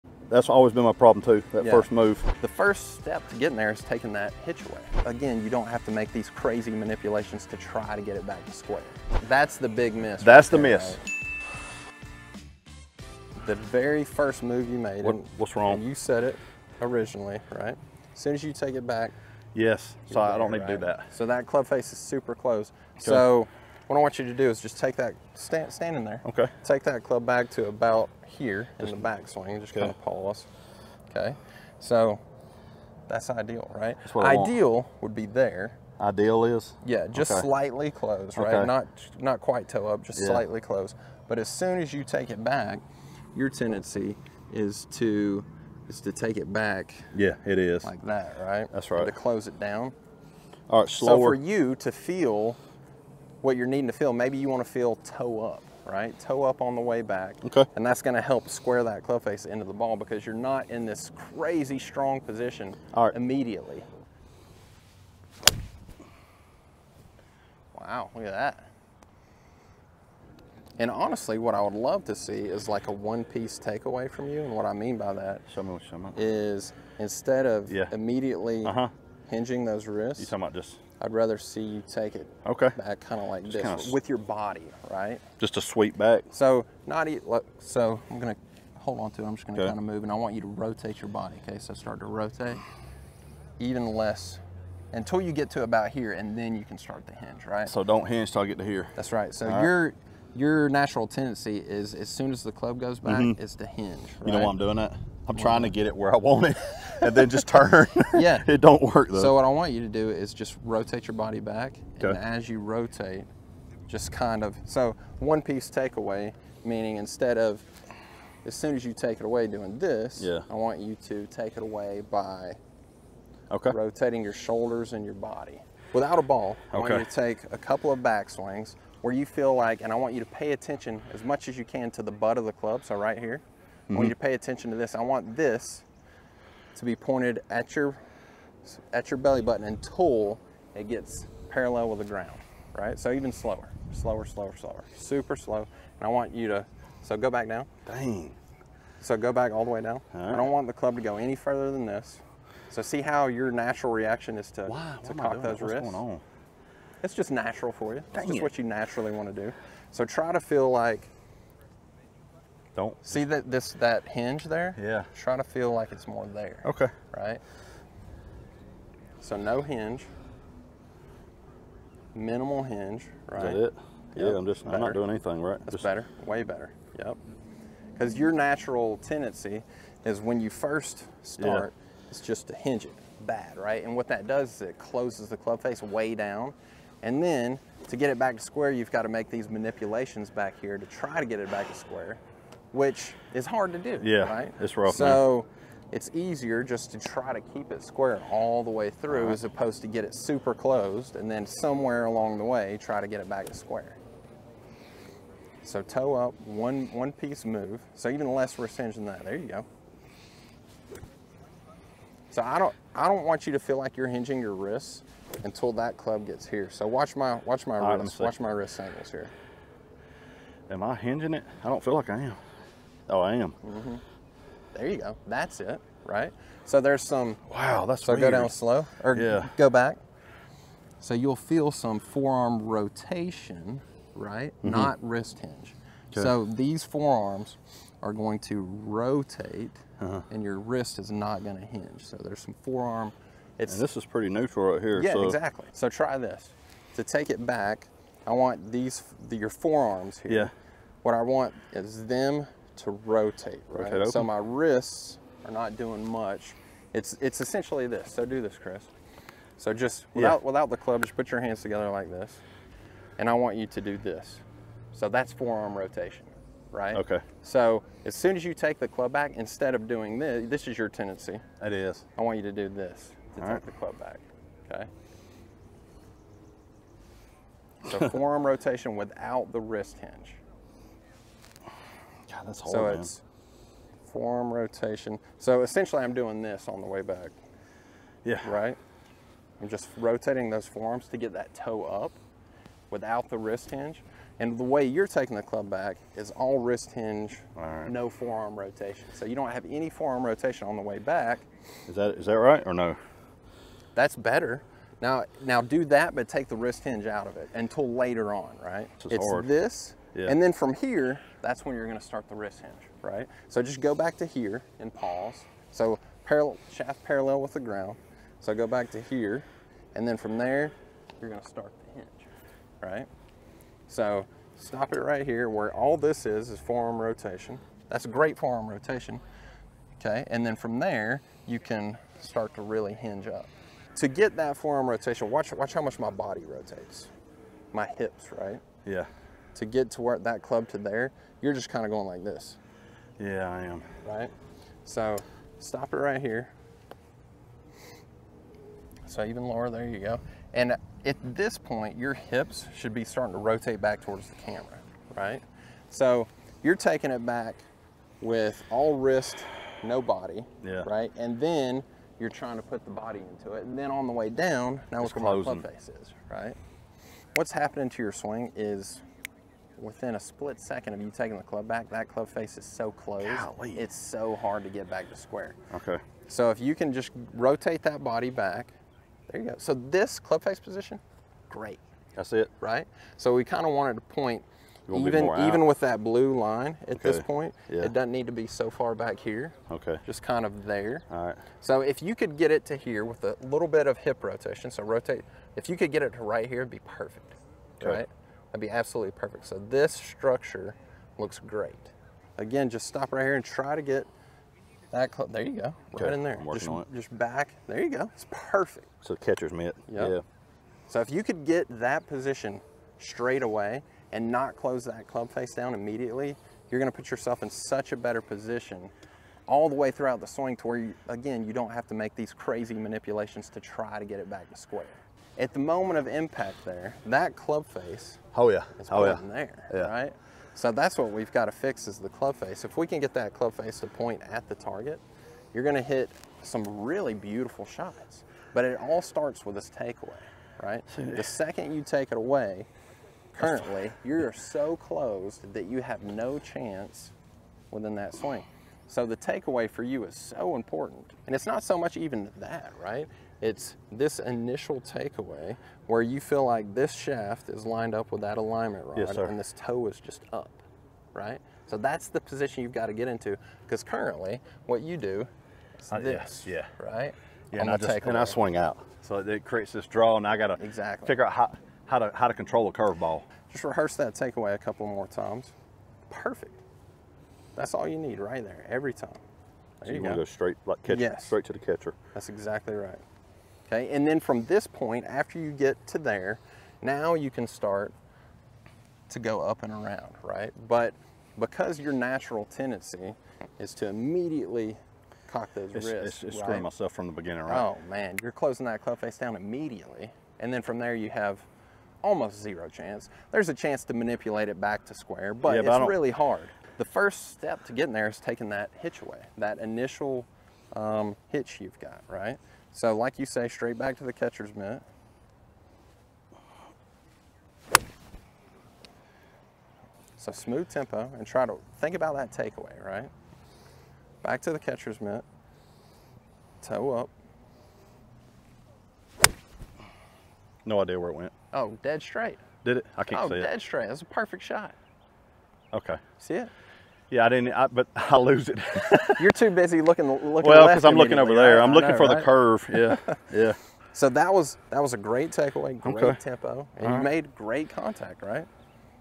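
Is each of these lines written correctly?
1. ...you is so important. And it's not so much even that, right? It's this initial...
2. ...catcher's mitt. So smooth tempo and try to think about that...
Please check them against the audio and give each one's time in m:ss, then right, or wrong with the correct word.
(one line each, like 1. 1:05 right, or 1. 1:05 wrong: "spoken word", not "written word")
1. 7:29 right
2. 8:34 right.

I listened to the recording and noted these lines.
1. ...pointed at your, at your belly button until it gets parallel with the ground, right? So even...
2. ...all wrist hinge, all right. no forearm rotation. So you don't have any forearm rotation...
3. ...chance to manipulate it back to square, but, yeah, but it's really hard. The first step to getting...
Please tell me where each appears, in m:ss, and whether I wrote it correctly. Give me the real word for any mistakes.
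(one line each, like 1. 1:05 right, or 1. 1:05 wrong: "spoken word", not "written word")
1. 2:16 right
2. 4:56 right
3. 8:23 right.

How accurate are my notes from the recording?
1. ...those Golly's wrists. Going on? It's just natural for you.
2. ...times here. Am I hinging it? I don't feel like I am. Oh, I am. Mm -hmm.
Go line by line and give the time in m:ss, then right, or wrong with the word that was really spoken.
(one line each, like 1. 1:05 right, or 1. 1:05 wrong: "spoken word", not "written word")
1. 2:35 wrong: "What", not "Golly"
2. 3:38 wrong: "angles", not "times".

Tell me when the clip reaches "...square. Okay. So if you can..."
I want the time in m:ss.
6:15.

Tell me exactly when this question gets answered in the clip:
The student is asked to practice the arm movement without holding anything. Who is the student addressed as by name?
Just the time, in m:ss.
4:18.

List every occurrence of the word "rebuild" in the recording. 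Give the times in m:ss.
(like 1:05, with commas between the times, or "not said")
not said.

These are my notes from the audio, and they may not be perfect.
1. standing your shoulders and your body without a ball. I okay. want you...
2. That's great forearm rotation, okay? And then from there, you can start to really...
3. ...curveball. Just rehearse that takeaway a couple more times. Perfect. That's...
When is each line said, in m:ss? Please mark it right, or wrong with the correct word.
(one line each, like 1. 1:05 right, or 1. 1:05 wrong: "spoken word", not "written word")
1. 2:03 wrong: "rotating", not "standing"
2. 5:27 right
3. 7:52 right.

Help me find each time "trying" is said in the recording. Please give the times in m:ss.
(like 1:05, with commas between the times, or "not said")
1:45, 6:02.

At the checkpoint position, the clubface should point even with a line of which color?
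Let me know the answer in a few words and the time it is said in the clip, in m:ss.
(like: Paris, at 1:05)
Blue, at 6:26.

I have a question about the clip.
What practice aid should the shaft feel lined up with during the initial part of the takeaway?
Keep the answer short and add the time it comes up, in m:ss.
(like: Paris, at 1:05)
Alignment rod, at 7:38.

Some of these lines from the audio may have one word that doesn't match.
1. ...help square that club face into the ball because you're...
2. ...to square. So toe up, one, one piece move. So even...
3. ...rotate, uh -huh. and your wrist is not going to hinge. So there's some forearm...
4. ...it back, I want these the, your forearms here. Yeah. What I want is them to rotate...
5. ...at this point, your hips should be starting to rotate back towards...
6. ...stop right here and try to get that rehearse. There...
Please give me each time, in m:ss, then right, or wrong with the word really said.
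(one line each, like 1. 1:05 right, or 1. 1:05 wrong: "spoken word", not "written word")
1. 0:58 right
2. 3:23 right
3. 3:58 right
4. 4:07 right
5. 5:51 right
6. 6:42 wrong: "close", not "rehearse".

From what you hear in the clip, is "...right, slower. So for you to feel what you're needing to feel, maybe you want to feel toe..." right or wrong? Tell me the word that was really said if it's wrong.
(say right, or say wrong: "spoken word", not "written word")
right.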